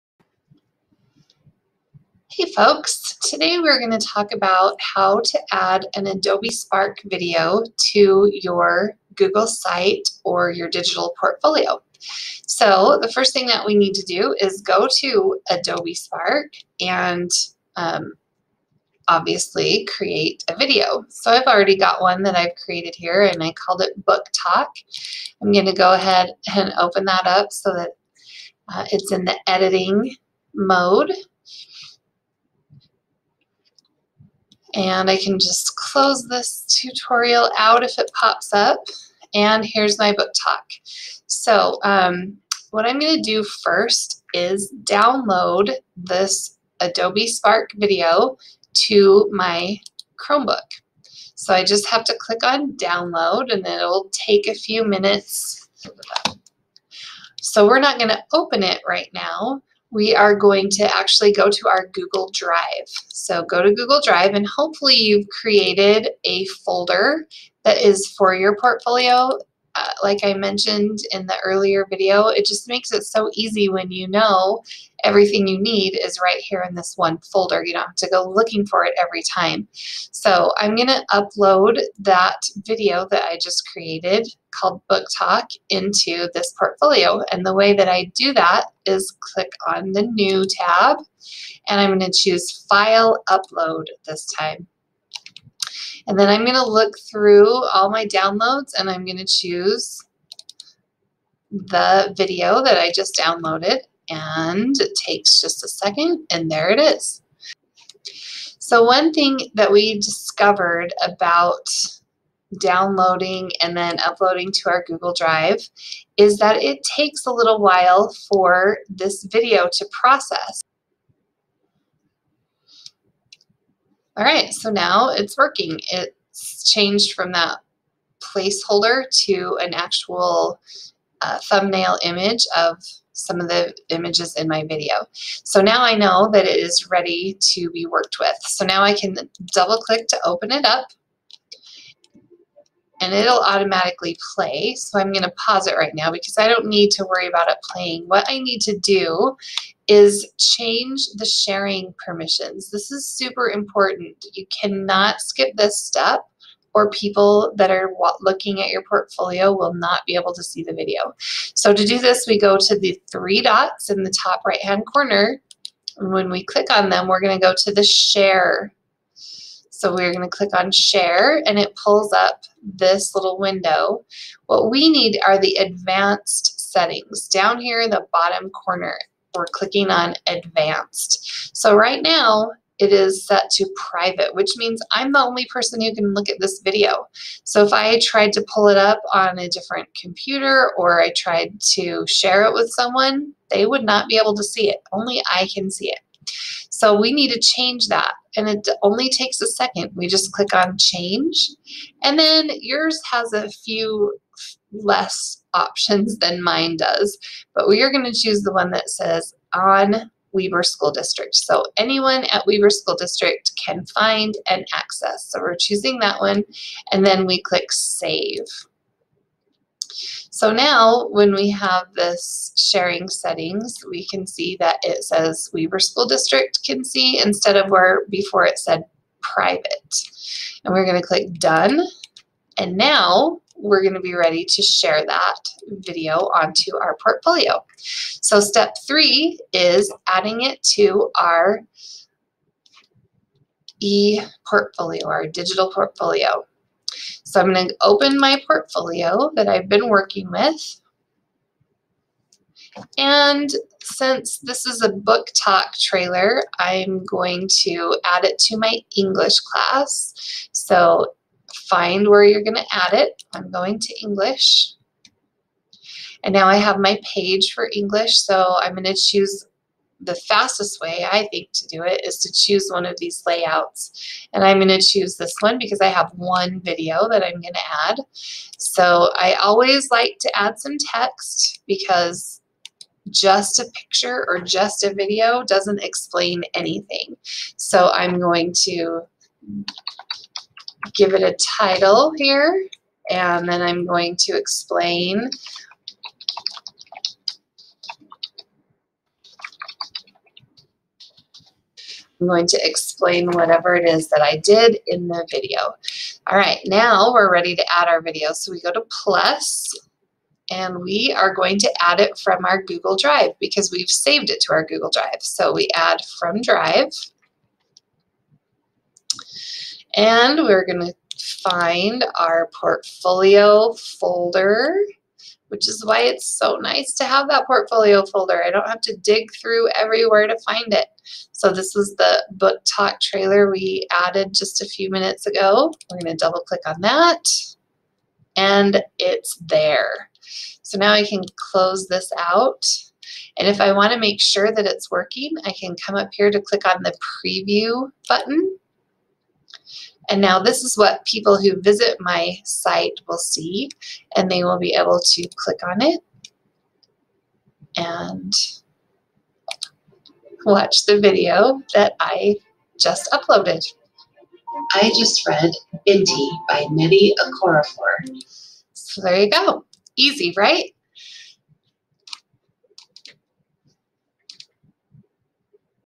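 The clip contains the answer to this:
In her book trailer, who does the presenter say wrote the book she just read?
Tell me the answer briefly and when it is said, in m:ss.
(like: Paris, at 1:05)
Nnedi Okorafor, at 6:06.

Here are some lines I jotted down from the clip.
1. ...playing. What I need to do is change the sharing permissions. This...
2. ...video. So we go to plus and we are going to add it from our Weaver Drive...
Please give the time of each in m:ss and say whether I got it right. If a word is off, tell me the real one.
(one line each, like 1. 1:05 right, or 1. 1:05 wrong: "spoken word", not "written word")
1. 2:27 right
2. 5:07 wrong: "Google", not "Weaver".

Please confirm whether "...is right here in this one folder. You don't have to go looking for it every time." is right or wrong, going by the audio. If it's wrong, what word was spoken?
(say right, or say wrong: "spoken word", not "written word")
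right.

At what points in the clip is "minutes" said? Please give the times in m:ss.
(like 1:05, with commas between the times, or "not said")
0:54, 5:34.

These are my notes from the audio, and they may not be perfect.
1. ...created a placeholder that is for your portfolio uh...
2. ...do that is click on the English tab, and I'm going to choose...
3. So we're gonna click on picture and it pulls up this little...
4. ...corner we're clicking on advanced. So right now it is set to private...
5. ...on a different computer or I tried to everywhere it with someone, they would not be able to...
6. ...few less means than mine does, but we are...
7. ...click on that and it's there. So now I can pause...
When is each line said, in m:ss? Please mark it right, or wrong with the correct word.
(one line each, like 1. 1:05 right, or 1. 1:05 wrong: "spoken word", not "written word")
1. 1:05 wrong: "folder", not "placeholder"
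2. 1:28 wrong: "New", not "English"
3. 2:49 wrong: "share", not "picture"
4. 2:58 right
5. 3:09 wrong: "share", not "everywhere"
6. 3:23 wrong: "options", not "means"
7. 5:36 wrong: "close", not "pause".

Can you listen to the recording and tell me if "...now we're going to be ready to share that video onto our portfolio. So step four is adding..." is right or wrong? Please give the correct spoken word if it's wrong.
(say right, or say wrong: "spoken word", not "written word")
wrong: "three", not "four".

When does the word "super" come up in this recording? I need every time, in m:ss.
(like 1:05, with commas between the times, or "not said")
2:33.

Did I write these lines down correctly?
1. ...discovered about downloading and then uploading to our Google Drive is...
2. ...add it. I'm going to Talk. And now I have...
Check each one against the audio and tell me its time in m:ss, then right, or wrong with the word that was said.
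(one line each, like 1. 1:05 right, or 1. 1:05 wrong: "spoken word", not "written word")
1. 1:49 right
2. 4:22 wrong: "English", not "Talk".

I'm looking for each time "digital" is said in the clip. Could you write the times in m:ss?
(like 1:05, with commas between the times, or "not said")
0:10, 4:05.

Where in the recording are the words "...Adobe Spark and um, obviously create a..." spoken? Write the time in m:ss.
0:15.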